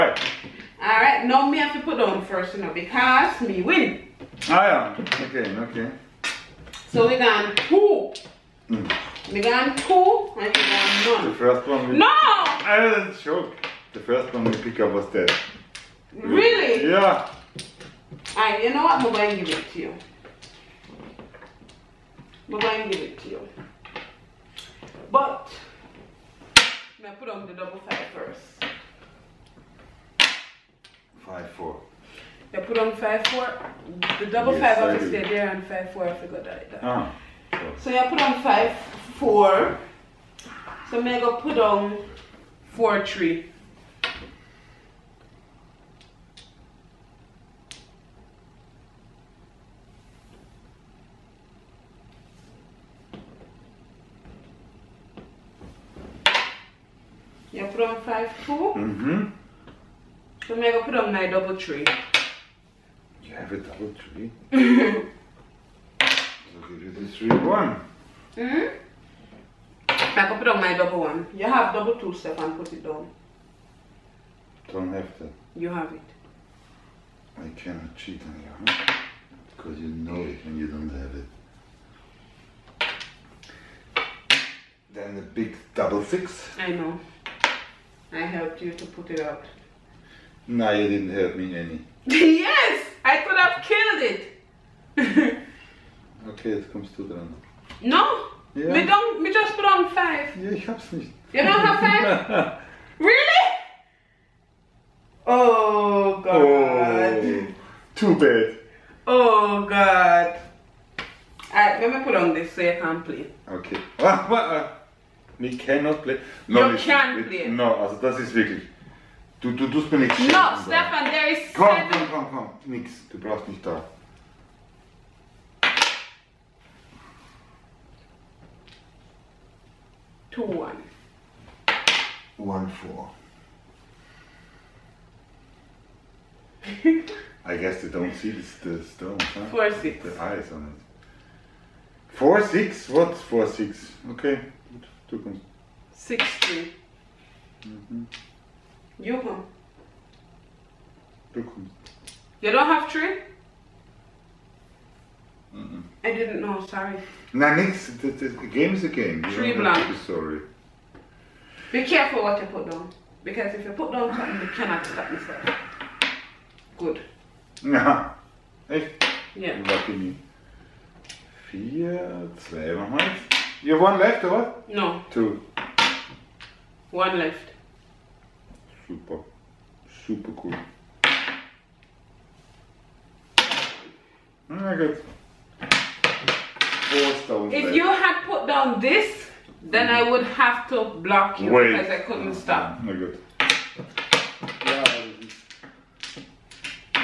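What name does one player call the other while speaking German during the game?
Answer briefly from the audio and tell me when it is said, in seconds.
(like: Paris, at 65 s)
Stefan, at 120 s.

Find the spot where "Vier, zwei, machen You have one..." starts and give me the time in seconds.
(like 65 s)
171 s.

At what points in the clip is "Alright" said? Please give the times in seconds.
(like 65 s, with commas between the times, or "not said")
0 s, 18 s, 111 s.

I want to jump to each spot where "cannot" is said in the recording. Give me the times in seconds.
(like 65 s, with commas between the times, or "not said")
77 s, 115 s, 164 s.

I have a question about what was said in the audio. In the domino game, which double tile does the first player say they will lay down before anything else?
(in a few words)
double five.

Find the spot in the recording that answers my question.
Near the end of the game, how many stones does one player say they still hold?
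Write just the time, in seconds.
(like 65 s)
186 s.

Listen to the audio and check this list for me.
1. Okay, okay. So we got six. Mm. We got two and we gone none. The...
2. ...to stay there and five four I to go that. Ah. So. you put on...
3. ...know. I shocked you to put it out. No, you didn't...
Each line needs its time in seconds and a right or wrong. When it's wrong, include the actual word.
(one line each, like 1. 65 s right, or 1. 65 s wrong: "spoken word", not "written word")
1. 5 s wrong: "two", not "six"
2. 35 s right
3. 86 s wrong: "helped", not "shocked".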